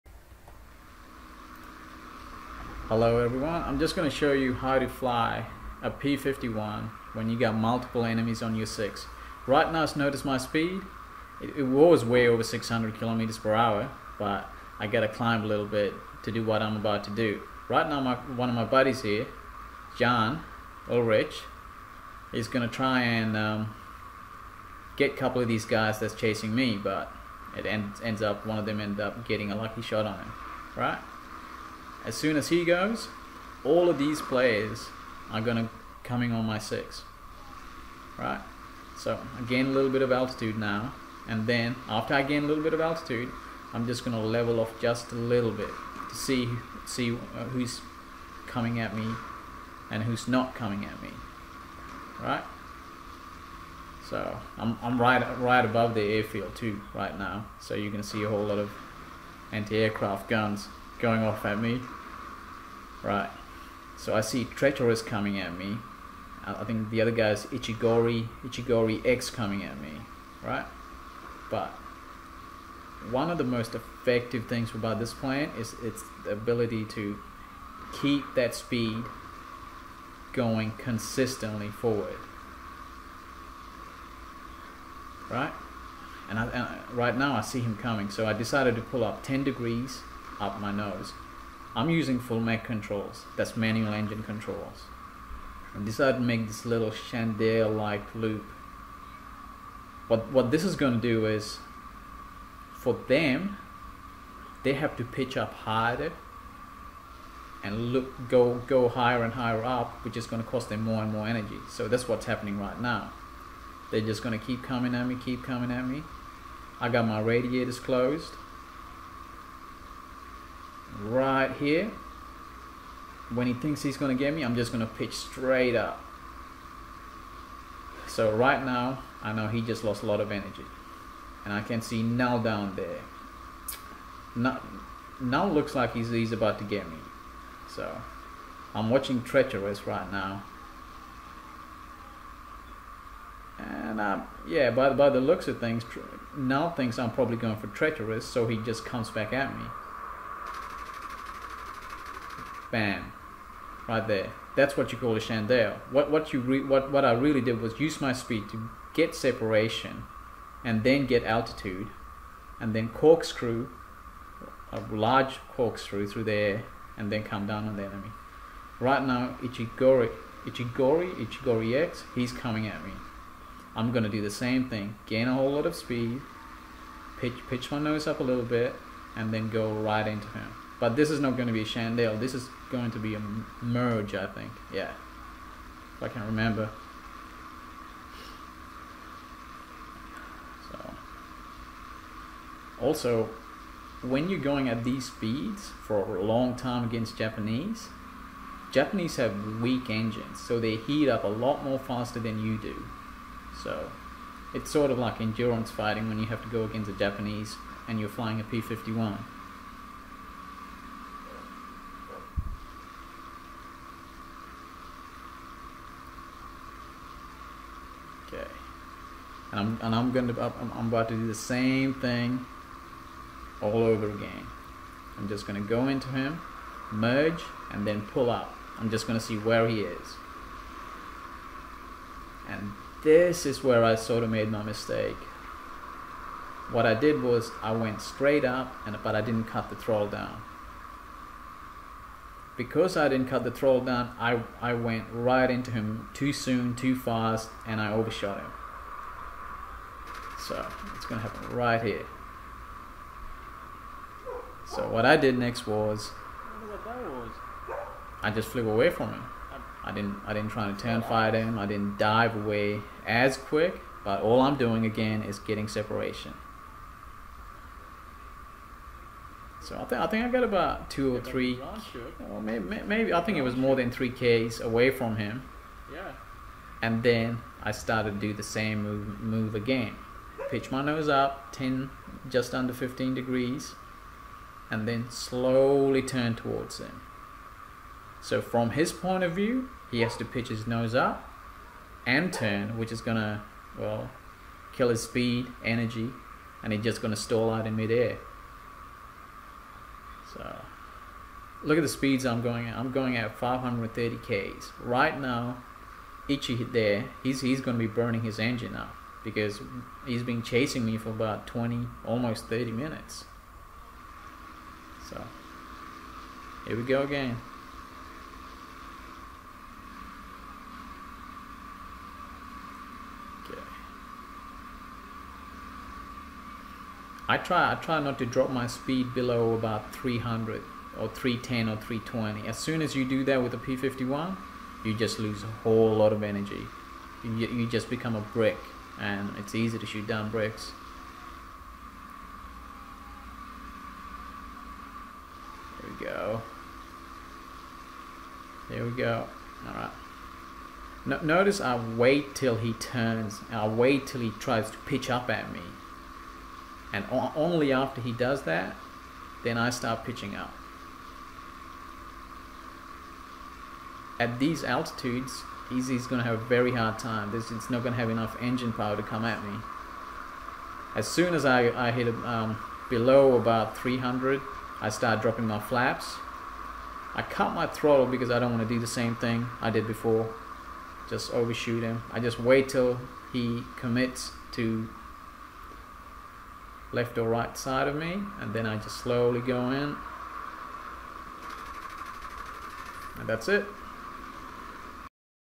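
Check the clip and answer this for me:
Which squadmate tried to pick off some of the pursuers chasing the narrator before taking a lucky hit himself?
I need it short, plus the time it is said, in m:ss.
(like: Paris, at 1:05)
John Ulrich, at 0:19.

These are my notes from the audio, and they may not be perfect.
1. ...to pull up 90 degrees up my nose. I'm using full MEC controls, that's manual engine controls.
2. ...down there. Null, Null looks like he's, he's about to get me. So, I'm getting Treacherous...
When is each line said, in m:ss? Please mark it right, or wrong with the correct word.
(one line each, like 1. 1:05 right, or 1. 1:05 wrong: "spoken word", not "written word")
1. 1:28 wrong: "10", not "90"
2. 2:12 wrong: "watching", not "getting".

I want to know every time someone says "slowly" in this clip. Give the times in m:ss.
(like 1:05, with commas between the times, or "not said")
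4:45, 6:28.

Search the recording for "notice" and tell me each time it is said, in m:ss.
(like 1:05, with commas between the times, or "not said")
0:09, 5:51.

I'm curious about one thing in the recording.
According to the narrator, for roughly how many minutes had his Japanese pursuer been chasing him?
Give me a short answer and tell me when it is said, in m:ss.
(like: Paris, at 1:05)
almost 30 minutes, at 5:12.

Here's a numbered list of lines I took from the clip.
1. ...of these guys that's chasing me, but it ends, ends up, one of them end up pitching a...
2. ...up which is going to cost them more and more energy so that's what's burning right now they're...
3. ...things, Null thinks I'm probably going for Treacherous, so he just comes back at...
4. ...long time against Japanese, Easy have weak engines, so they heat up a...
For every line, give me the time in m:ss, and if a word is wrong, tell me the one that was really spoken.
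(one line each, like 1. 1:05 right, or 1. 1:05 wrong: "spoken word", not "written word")
1. 0:25 wrong: "getting", not "pitching"
2. 1:49 wrong: "happening", not "burning"
3. 2:25 right
4. 3:16 wrong: "Japanese", not "Easy".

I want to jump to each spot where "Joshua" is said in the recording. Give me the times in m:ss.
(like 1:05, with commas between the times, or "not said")
not said.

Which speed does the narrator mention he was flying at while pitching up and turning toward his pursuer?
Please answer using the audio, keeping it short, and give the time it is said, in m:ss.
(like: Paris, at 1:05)
530 km/h, at 5:03.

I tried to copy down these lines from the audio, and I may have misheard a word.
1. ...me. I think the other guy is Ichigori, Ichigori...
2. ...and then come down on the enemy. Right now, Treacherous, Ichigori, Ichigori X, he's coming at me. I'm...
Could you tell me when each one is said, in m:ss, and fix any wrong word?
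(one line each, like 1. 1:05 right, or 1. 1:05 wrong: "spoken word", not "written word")
1. 1:05 right
2. 2:46 wrong: "Ichigori", not "Treacherous".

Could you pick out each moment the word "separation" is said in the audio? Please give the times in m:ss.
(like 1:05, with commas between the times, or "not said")
2:39, 4:25.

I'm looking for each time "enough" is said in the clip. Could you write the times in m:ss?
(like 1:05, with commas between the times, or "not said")
6:08.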